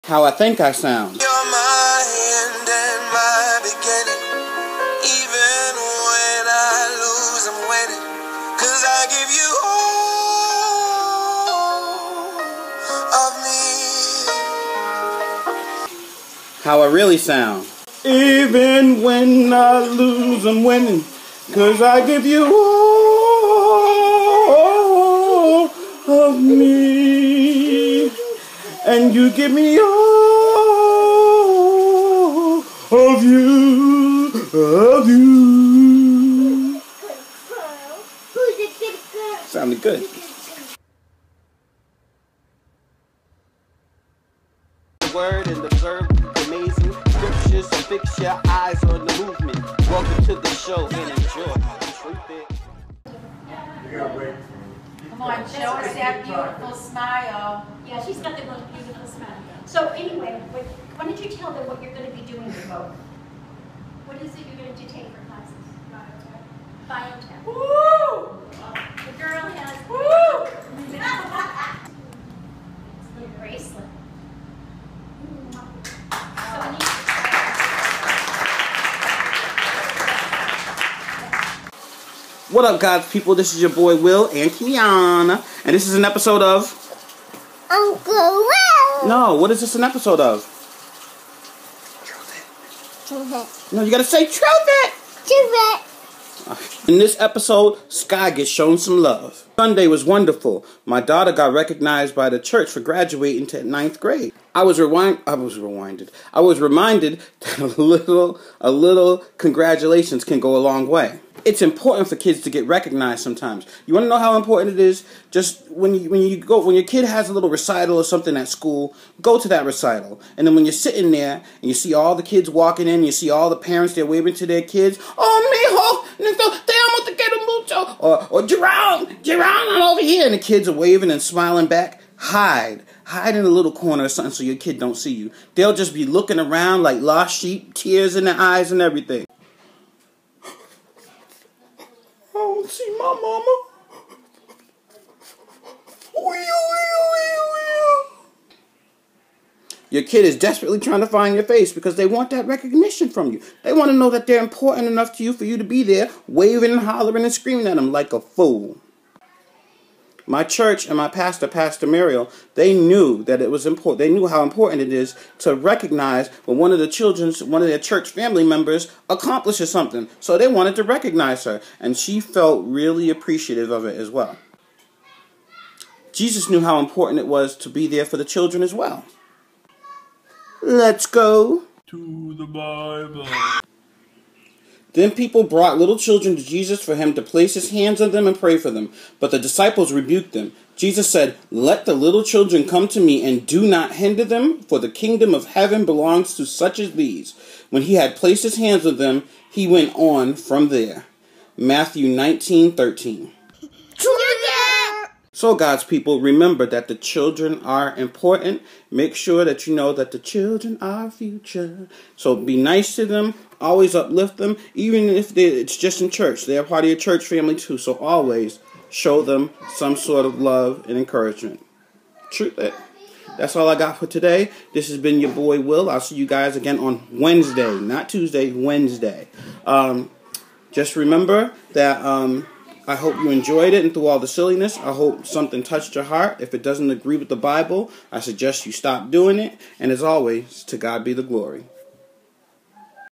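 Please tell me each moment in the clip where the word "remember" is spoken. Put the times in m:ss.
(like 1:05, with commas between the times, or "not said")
3:26, 3:50.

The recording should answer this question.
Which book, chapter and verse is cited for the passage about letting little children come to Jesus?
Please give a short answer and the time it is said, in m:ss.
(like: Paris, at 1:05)
Matthew 19:13, at 3:21.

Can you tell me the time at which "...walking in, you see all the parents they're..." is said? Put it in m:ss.
2:02.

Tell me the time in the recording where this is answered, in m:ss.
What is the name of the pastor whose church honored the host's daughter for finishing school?
2:41.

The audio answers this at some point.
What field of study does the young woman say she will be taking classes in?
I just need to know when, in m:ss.
1:05.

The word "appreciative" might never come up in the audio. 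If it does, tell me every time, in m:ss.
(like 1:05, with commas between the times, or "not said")
2:53.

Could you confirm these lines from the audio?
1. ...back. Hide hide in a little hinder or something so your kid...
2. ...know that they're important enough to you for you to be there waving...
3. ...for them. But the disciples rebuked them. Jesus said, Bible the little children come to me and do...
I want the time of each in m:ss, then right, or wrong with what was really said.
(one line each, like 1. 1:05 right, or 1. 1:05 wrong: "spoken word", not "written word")
1. 2:11 wrong: "corner", not "hinder"
2. 2:33 right
3. 3:08 wrong: "Let", not "Bible".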